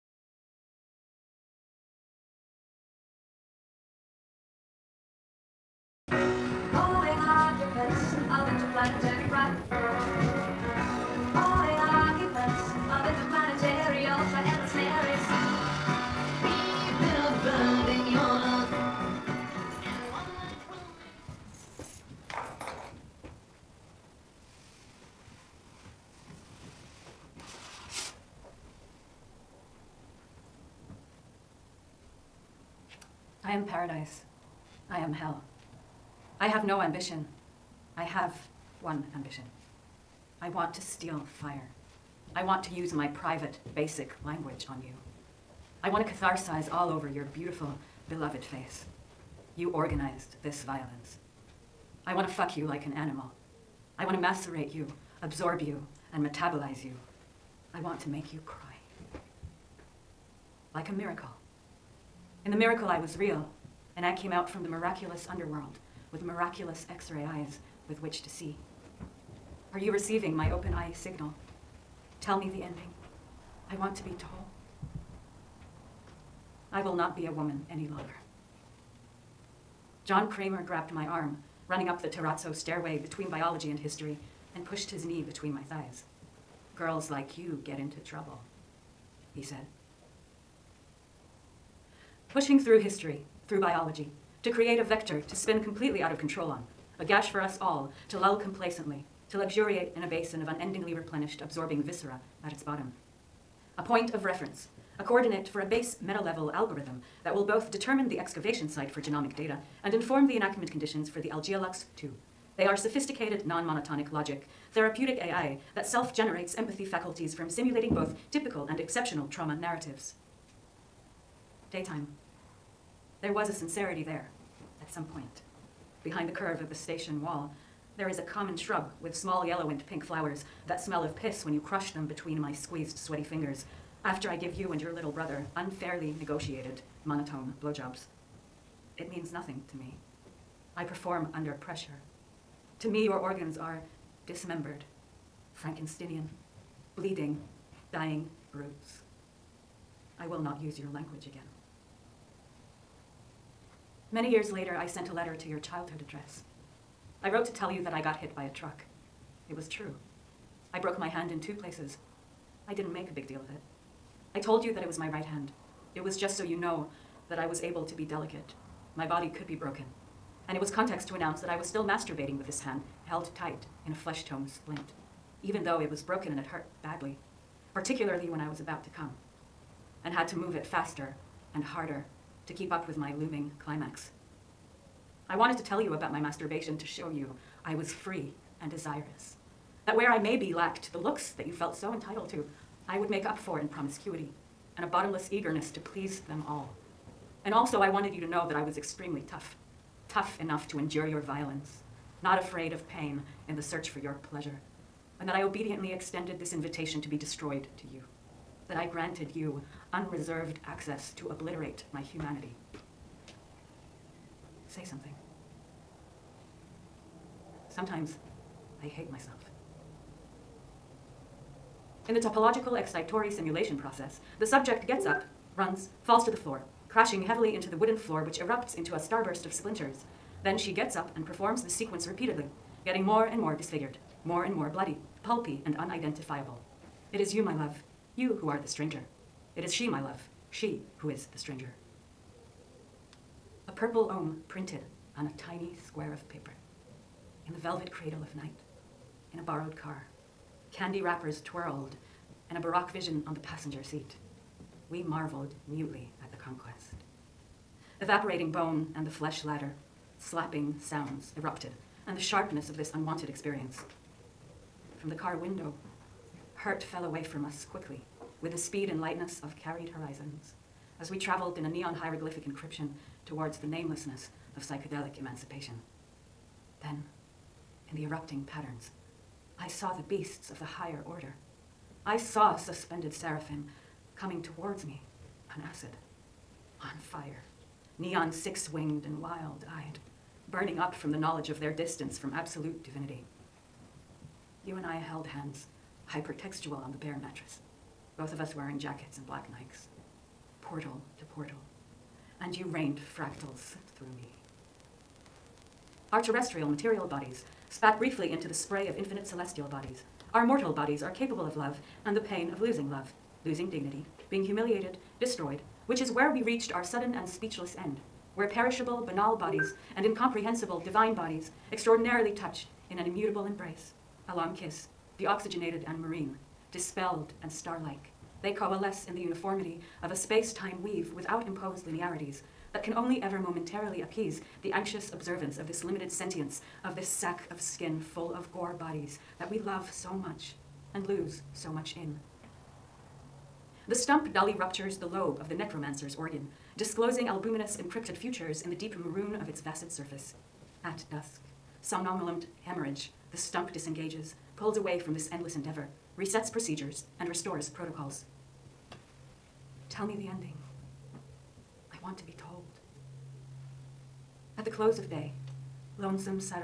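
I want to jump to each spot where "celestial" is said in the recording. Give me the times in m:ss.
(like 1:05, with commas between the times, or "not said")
5:09.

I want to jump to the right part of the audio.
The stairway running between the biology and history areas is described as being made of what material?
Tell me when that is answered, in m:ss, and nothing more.
1:22.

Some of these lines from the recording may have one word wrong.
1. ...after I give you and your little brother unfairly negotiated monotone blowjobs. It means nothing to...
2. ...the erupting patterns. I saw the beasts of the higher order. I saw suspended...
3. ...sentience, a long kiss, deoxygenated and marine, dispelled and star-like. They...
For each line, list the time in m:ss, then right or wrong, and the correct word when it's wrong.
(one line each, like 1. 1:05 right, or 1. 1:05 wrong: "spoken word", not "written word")
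1. 2:14 right
2. 4:37 right
3. 5:23 wrong: "embrace", not "sentience".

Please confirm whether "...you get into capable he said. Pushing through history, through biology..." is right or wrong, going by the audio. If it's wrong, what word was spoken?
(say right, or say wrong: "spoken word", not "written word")
wrong: "trouble", not "capable".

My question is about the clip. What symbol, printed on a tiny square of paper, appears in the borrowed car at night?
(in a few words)
purple ohm.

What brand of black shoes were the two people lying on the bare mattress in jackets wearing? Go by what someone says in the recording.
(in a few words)
Nikes.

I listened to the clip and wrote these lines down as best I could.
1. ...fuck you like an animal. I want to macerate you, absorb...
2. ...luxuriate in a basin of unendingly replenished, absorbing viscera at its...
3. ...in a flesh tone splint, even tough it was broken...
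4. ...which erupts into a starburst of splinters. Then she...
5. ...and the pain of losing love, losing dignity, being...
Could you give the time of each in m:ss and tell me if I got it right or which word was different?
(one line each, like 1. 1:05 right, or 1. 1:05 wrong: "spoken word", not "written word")
1. 0:52 right
2. 1:39 right
3. 2:53 wrong: "though", not "tough"
4. 3:48 right
5. 5:12 right.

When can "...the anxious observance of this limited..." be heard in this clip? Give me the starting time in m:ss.
5:34.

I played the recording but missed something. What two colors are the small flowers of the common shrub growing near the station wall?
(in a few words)
yellow and pink.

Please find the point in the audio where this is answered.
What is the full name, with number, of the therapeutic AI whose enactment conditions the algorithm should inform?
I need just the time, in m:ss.
1:51.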